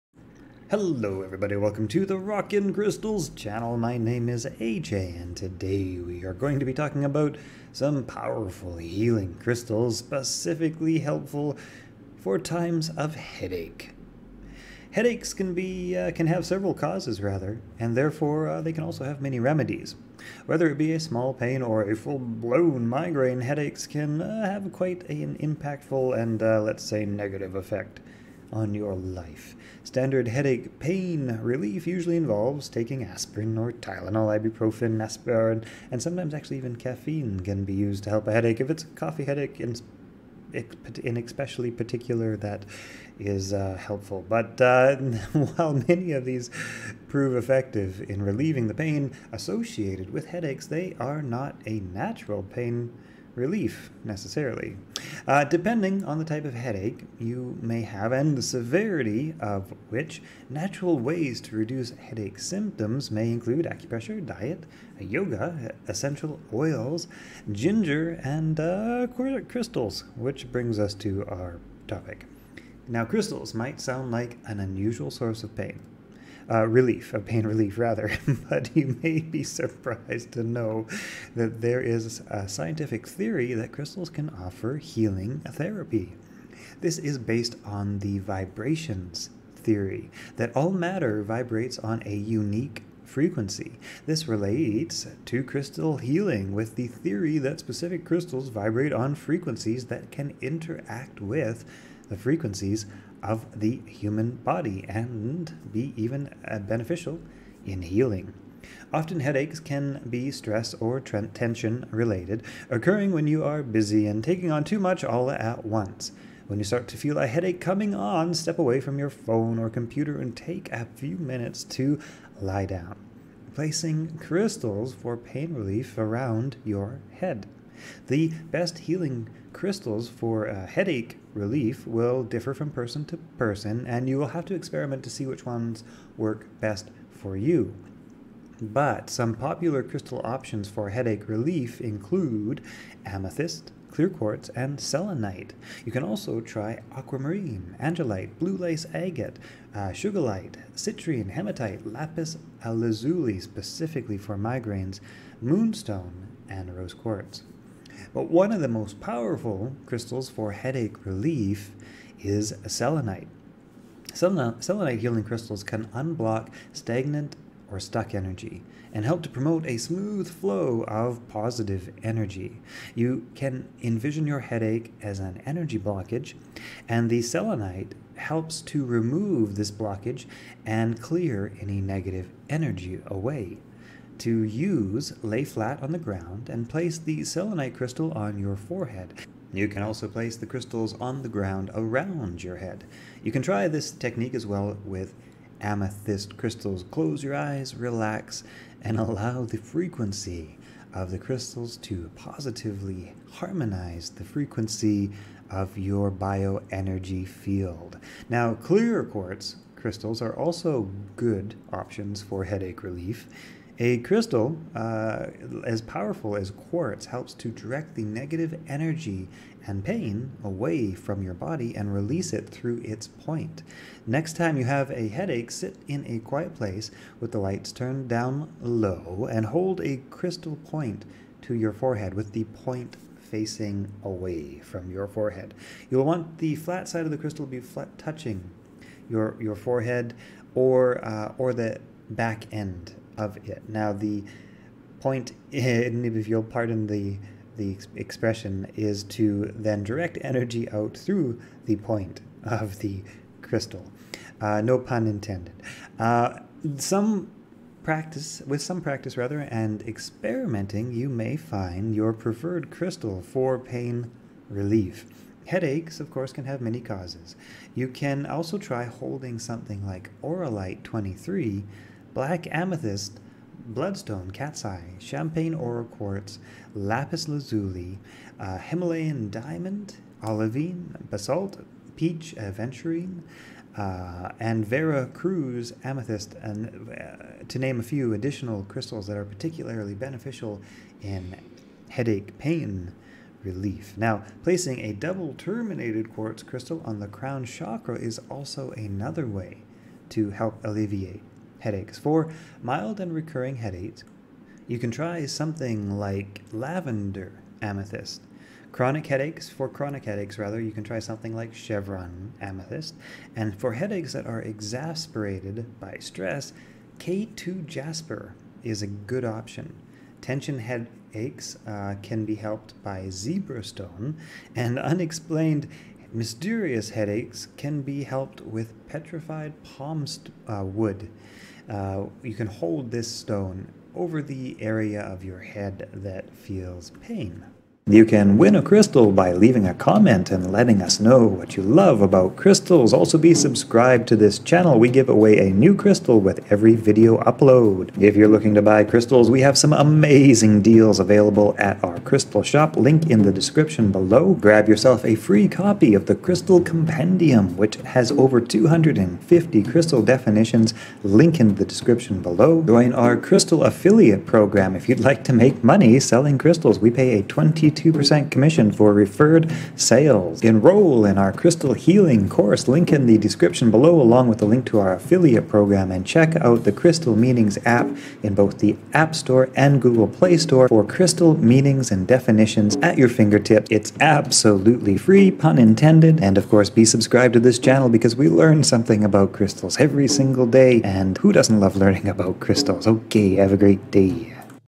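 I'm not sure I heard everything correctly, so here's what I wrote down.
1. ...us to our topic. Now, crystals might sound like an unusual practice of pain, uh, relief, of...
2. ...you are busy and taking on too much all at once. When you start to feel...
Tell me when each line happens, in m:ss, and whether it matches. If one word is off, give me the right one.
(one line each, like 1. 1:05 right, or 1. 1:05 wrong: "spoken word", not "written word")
1. 1:10 wrong: "source", not "practice"
2. 1:53 right.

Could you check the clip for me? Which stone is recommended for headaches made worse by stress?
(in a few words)
K2 jasper.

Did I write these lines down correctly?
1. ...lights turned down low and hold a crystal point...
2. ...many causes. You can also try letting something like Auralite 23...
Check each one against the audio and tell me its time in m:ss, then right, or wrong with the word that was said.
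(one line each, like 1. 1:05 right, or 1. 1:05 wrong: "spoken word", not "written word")
1. 3:47 right
2. 4:26 wrong: "holding", not "letting".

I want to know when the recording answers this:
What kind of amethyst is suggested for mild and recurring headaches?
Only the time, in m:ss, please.
5:06.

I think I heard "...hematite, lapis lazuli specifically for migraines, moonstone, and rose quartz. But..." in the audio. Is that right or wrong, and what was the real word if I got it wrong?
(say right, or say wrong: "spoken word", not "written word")
right.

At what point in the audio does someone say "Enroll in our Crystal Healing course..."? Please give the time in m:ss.
6:10.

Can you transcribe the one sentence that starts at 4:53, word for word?
Now, placing a double terminated quartz crystal on the crown chakra is also another way to help alleviate headaches.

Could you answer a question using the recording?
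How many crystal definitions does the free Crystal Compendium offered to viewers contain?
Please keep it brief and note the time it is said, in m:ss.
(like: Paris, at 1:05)
Over 250, at 5:58.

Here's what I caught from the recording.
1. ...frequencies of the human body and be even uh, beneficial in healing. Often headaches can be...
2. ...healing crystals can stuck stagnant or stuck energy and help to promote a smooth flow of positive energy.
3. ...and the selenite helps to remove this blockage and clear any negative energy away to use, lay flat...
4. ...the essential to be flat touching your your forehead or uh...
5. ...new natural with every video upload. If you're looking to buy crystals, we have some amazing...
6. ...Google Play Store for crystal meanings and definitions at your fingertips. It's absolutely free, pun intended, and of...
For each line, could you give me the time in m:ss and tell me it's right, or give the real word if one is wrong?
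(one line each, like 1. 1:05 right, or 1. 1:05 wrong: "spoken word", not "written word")
1. 1:42 right
2. 2:44 wrong: "unblock", not "stuck"
3. 2:56 right
4. 3:57 wrong: "crystal", not "essential"
5. 5:45 wrong: "crystal", not "natural"
6. 6:19 right.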